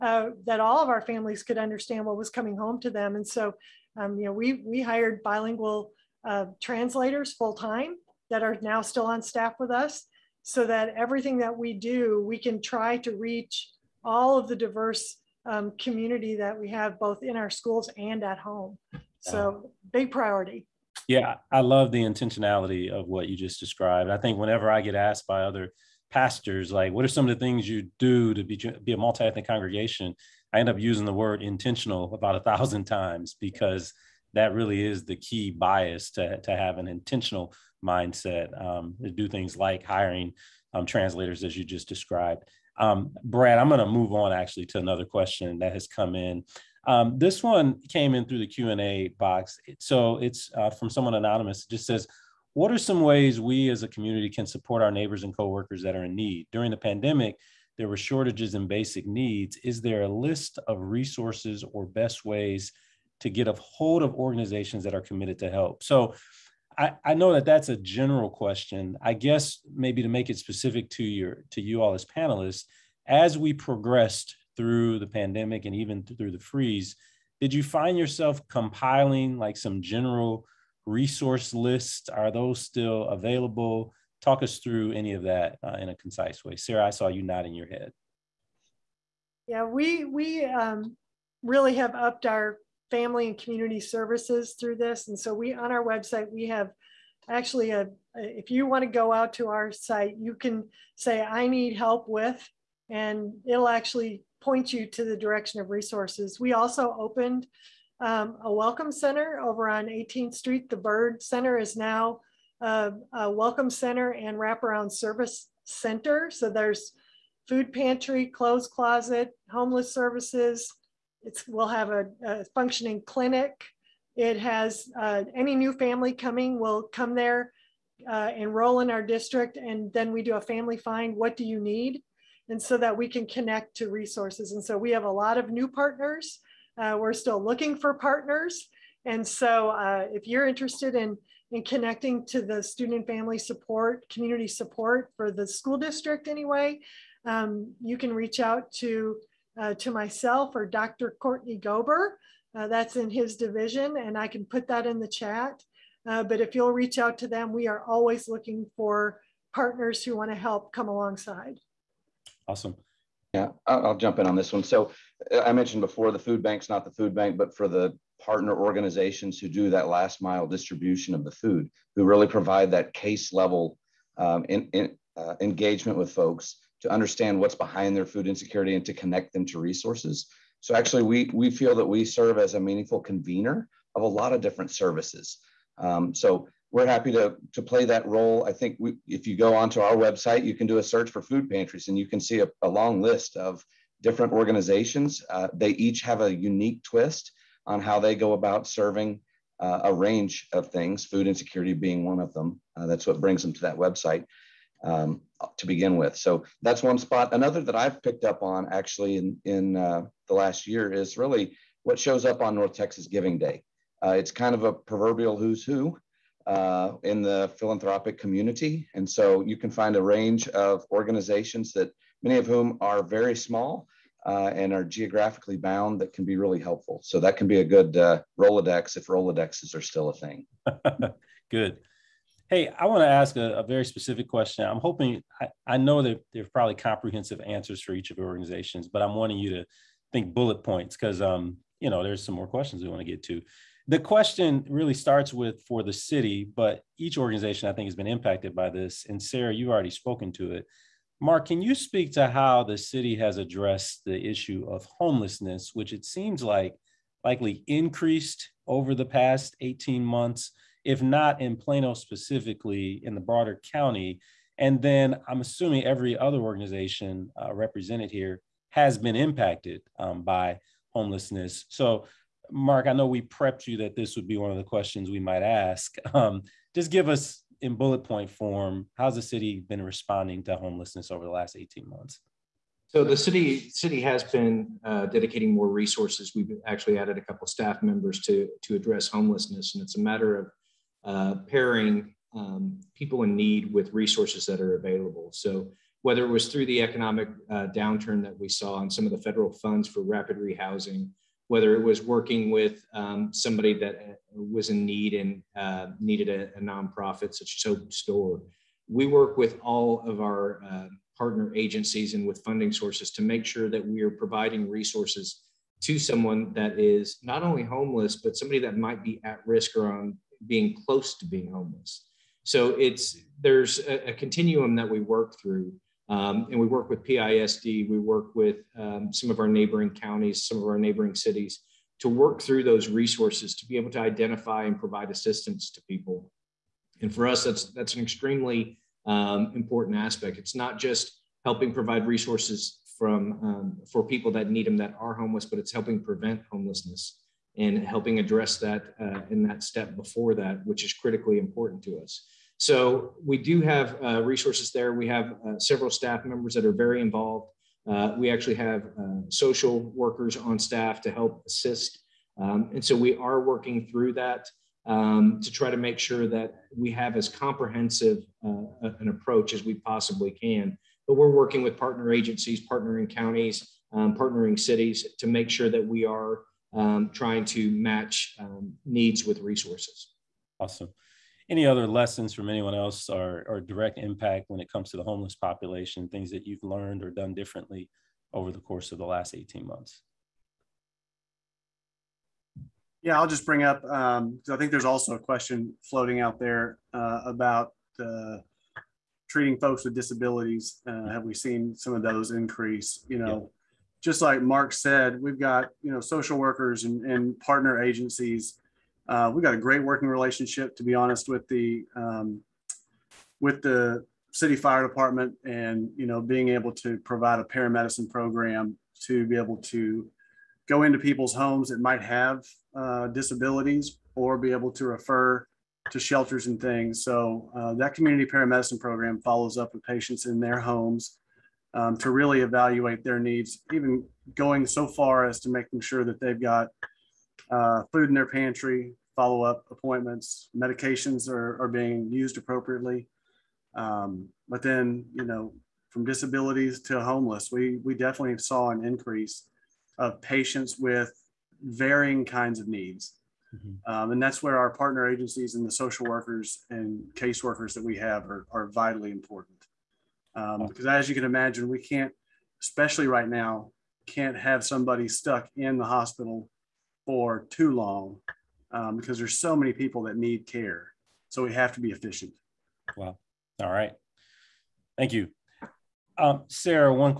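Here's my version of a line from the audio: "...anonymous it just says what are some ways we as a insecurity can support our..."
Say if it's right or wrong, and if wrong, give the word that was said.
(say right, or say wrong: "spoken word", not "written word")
wrong: "community", not "insecurity".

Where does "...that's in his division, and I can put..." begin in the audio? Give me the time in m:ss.
2:32.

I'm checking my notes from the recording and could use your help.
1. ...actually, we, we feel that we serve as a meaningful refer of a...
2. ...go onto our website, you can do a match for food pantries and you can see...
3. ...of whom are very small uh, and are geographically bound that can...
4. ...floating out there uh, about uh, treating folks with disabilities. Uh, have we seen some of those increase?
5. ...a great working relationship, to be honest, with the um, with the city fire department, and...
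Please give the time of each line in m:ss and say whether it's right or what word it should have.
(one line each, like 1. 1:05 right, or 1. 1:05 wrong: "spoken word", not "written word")
1. 3:00 wrong: "convener", not "refer"
2. 3:09 wrong: "search", not "match"
3. 3:42 right
4. 6:35 right
5. 6:49 right.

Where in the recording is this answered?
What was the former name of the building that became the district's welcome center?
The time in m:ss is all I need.
1:50.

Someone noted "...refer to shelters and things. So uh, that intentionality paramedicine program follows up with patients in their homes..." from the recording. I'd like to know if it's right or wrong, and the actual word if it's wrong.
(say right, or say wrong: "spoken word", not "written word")
wrong: "community", not "intentionality".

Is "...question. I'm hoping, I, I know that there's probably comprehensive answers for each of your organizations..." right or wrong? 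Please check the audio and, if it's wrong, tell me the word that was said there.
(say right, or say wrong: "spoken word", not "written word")
right.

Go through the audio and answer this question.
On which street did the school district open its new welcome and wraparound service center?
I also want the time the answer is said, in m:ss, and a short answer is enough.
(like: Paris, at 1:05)
18th Street, at 1:49.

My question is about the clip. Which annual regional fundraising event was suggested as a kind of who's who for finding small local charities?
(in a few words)
North Texas Giving Day.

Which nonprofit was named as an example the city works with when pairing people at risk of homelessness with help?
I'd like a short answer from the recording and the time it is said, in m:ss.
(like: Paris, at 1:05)
Hope's Door, at 5:07.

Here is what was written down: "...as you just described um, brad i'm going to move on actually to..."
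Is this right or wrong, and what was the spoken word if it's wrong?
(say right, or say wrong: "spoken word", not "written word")
right.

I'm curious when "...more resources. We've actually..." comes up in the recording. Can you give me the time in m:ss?
4:45.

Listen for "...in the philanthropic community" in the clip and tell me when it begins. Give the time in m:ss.
3:37.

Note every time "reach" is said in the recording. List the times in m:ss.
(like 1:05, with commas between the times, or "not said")
0:13, 2:28, 2:36.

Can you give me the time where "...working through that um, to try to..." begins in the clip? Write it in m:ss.
6:03.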